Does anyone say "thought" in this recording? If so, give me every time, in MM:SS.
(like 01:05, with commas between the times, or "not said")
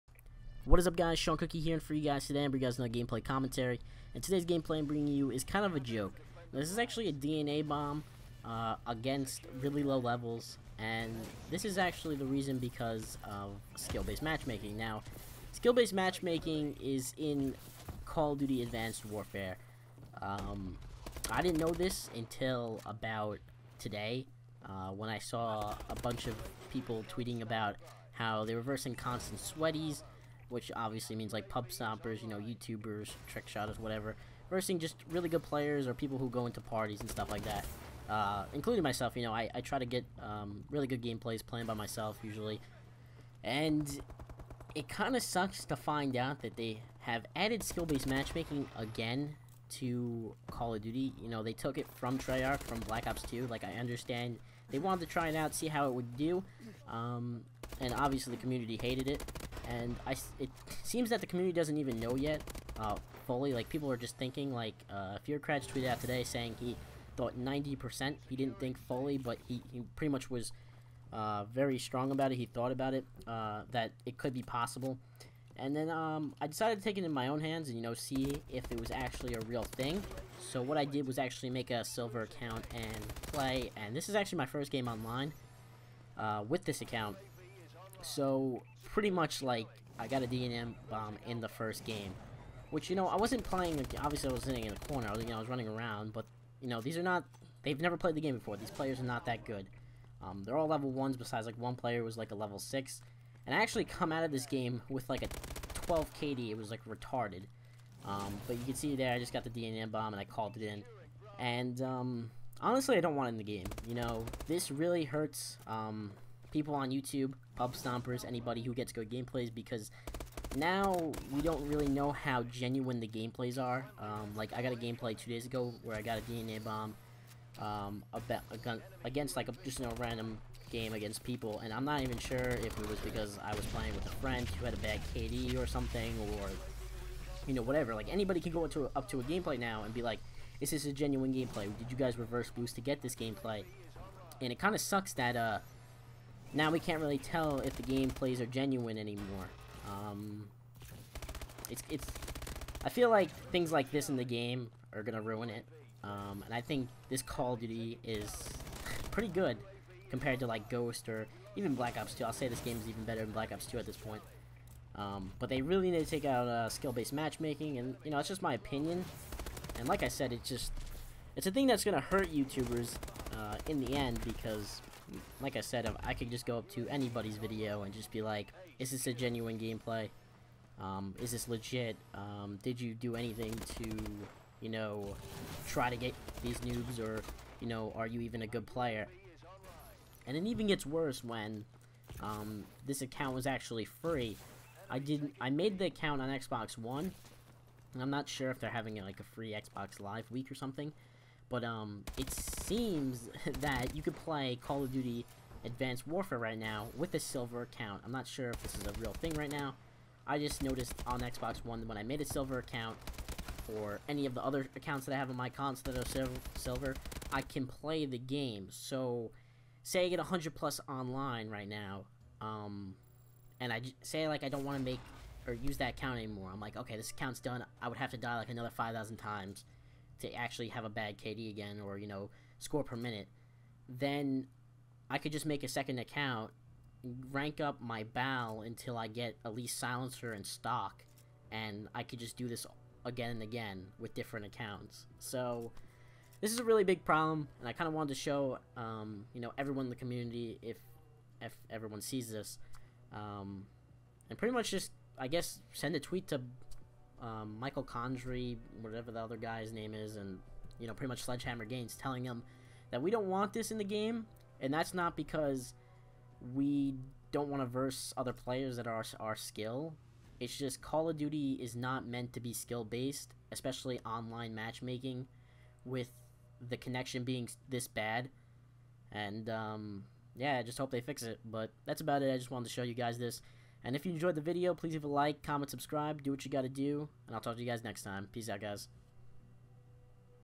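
01:07, 01:12.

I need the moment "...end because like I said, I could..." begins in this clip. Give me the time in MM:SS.
02:53.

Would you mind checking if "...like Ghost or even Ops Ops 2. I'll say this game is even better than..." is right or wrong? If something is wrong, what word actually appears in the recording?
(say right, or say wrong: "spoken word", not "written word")
wrong: "Black", not "Ops".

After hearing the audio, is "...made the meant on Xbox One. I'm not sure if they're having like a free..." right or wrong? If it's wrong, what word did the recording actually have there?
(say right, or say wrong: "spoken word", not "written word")
wrong: "account", not "meant".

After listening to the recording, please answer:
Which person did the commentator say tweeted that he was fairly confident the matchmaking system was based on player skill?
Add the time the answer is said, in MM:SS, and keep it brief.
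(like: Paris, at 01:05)
Fearcratch, at 01:05.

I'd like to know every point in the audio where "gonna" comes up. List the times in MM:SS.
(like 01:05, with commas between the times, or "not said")
02:35, 02:51.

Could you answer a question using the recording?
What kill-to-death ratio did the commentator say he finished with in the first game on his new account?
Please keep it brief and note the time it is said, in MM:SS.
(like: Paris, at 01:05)
12, at 01:45.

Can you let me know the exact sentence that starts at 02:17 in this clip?
Like anybody can go into a, up to a gameplay now and be like, "Is this a genuine gameplay?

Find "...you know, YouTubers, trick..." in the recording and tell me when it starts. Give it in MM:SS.
00:32.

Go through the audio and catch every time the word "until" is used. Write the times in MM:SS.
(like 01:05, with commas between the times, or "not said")
00:22, 03:58.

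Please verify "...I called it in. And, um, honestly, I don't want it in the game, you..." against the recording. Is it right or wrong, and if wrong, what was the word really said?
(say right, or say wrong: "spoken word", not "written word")
right.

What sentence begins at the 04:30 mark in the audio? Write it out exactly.
It's just Call of Duty is not meant to be skill based, especially online matchmaking, with the connection being this bad.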